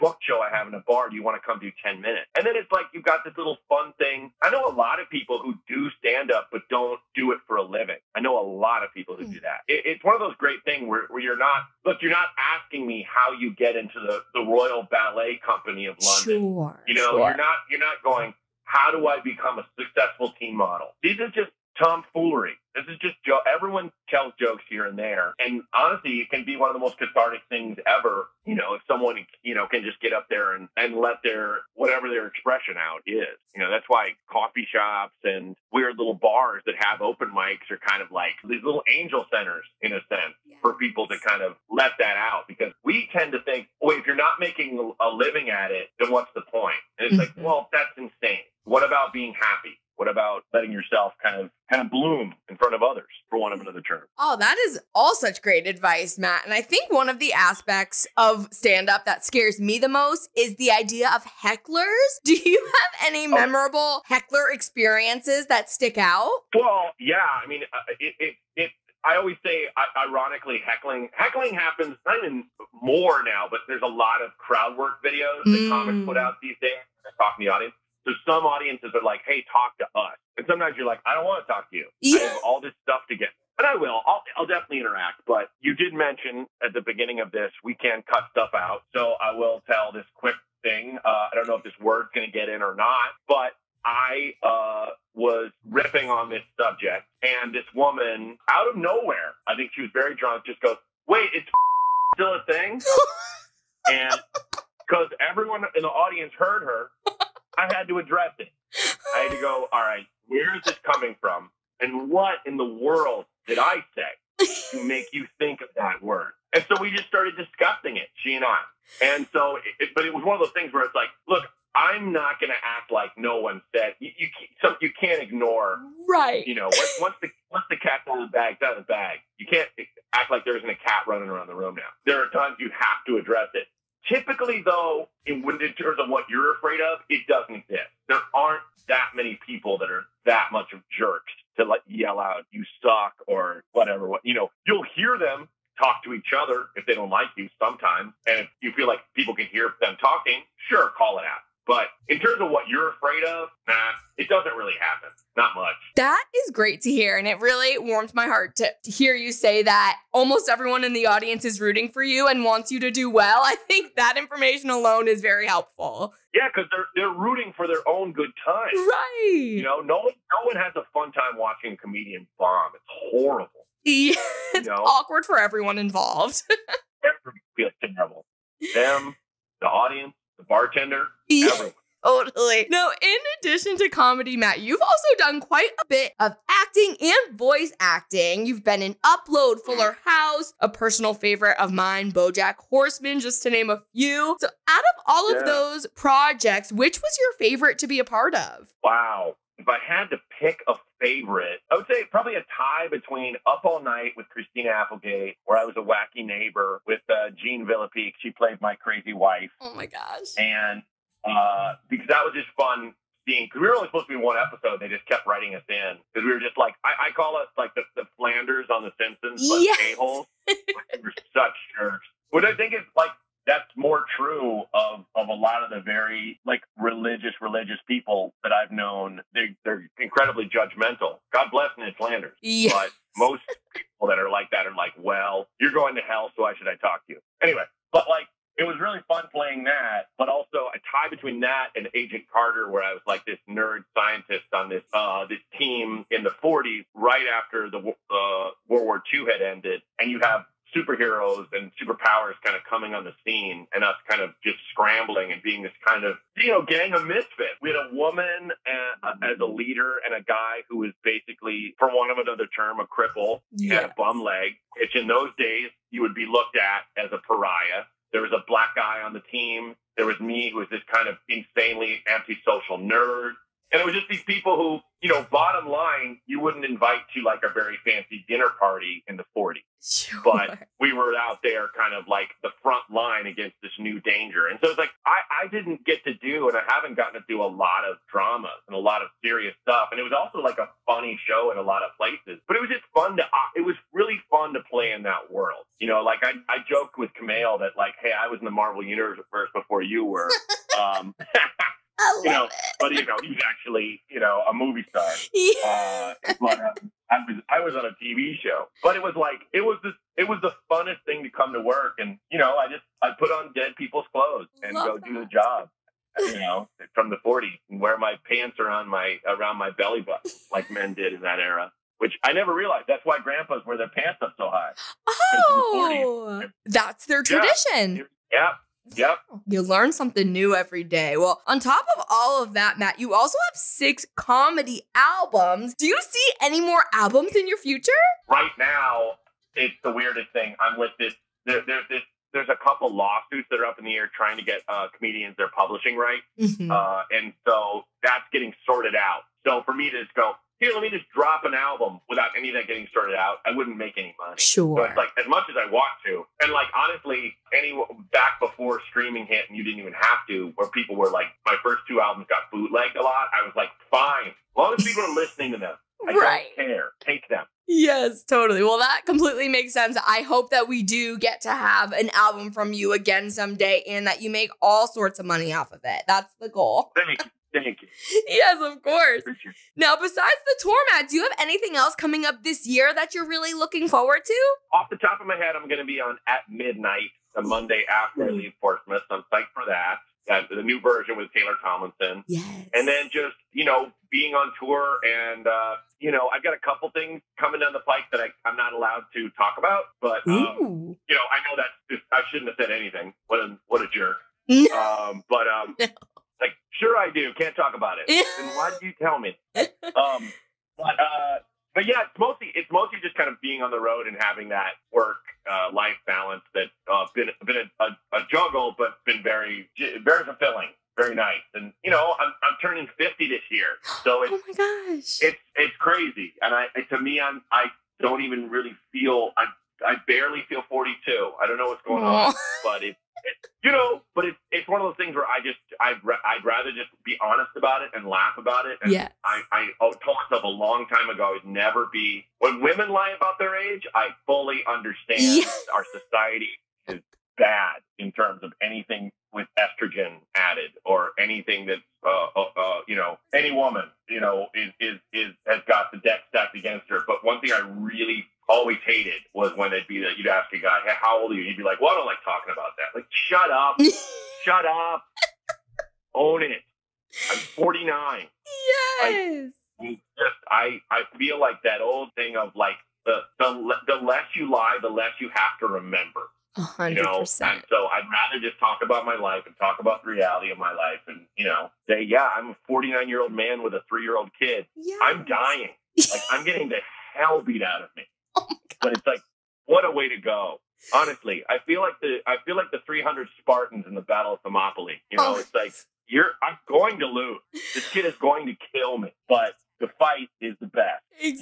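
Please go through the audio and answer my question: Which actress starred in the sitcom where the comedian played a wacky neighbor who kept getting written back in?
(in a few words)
Christina Applegate.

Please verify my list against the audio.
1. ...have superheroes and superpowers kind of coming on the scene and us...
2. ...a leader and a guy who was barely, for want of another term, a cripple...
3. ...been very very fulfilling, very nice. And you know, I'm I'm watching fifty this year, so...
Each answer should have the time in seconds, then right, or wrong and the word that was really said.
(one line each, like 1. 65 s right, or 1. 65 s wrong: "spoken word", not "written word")
1. 250 s right
2. 259 s wrong: "basically", not "barely"
3. 419 s wrong: "turning", not "watching".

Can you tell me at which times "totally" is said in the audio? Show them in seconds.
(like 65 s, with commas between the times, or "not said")
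182 s, 368 s.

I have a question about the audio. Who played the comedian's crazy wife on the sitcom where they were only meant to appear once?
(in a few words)
Jean Villepique.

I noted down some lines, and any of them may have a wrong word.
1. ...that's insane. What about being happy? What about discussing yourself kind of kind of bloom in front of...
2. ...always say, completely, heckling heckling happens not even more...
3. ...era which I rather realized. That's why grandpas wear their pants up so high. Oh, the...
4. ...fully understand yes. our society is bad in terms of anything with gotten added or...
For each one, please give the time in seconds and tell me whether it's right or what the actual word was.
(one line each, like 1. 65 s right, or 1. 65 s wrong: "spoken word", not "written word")
1. 47 s wrong: "letting", not "discussing"
2. 69 s wrong: "ironically", not "completely"
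3. 321 s wrong: "never", not "rather"
4. 444 s wrong: "estrogen", not "gotten".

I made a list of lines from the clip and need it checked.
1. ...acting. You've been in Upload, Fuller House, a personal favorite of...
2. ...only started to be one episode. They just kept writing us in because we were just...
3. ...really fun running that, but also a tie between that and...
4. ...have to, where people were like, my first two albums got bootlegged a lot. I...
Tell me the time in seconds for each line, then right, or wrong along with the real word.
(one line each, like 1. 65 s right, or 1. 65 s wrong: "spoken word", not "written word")
1. 187 s right
2. 213 s wrong: "supposed", not "started"
3. 238 s wrong: "playing", not "running"
4. 359 s right.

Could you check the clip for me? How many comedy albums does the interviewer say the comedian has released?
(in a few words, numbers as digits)
6.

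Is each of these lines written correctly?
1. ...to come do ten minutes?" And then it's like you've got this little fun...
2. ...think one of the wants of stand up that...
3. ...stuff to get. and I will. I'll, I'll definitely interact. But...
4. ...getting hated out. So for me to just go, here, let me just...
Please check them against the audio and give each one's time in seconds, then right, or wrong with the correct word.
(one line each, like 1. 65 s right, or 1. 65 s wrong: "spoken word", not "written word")
1. 1 s right
2. 56 s wrong: "aspects", not "wants"
3. 82 s right
4. 348 s wrong: "sorted", not "hated".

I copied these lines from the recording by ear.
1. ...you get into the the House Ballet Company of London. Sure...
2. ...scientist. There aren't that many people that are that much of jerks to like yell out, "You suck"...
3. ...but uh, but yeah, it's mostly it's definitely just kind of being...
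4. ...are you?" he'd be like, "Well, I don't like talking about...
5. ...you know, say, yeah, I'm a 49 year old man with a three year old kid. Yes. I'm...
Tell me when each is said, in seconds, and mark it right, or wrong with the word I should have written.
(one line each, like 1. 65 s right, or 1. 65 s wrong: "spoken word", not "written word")
1. 13 s wrong: "Royal", not "House"
2. 137 s wrong: "exist", not "scientist"
3. 410 s wrong: "mostly", not "definitely"
4. 461 s right
5. 481 s right.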